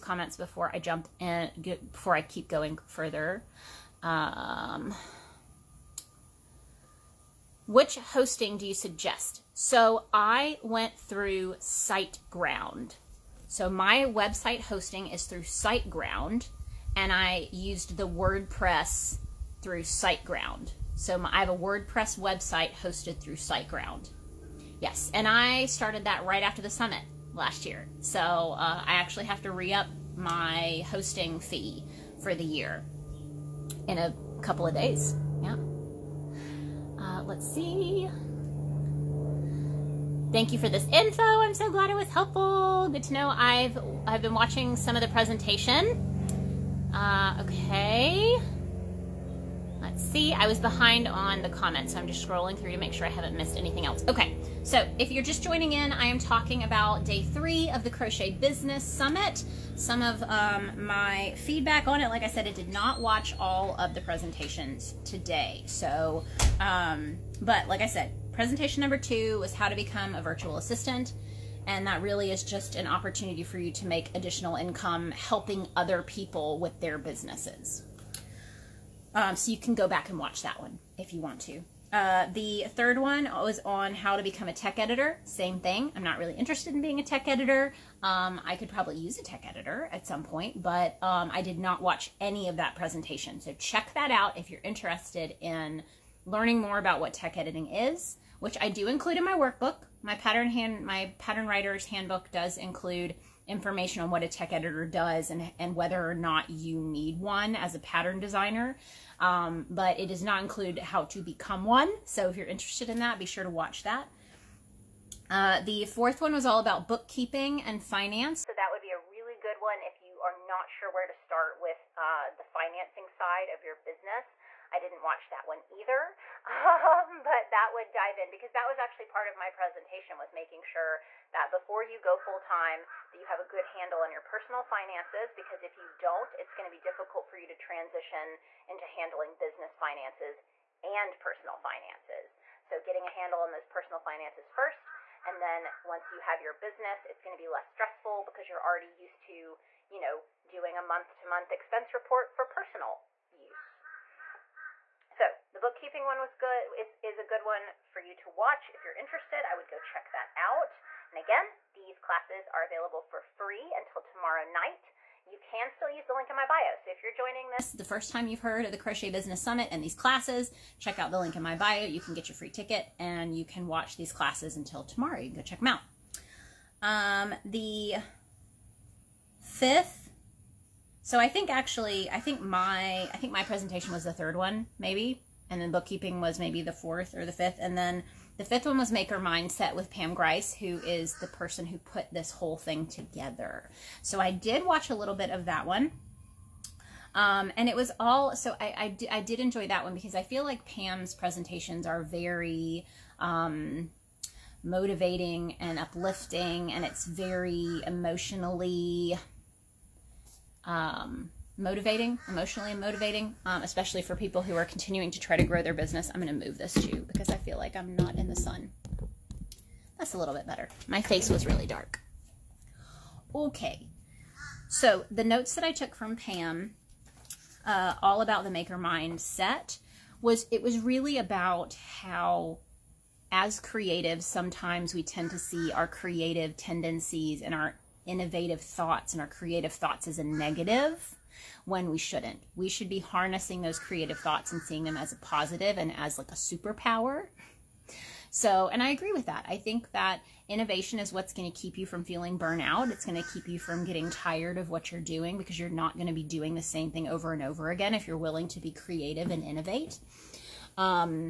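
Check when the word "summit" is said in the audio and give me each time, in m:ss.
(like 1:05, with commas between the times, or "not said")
0:26, 0:58, 2:49.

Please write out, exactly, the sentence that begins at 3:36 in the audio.
I'm going to move this too because I feel like I'm not in the sun.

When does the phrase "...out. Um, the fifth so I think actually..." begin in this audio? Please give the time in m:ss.
2:55.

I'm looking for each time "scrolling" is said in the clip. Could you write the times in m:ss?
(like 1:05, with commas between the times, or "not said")
0:52.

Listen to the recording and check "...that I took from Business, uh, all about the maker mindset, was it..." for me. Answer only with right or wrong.
wrong.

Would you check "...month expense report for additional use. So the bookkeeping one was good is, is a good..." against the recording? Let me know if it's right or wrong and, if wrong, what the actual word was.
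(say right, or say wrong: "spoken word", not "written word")
wrong: "personal", not "additional".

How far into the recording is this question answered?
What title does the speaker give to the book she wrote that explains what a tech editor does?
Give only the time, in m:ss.
1:41.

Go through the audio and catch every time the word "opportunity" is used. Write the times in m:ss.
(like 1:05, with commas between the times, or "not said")
1:12.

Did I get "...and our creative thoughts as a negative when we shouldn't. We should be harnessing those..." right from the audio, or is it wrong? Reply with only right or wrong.
right.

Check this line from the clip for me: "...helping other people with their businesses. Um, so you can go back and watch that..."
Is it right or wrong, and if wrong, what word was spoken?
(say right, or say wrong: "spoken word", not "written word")
right.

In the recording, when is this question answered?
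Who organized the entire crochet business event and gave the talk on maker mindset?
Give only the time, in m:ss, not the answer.
3:09.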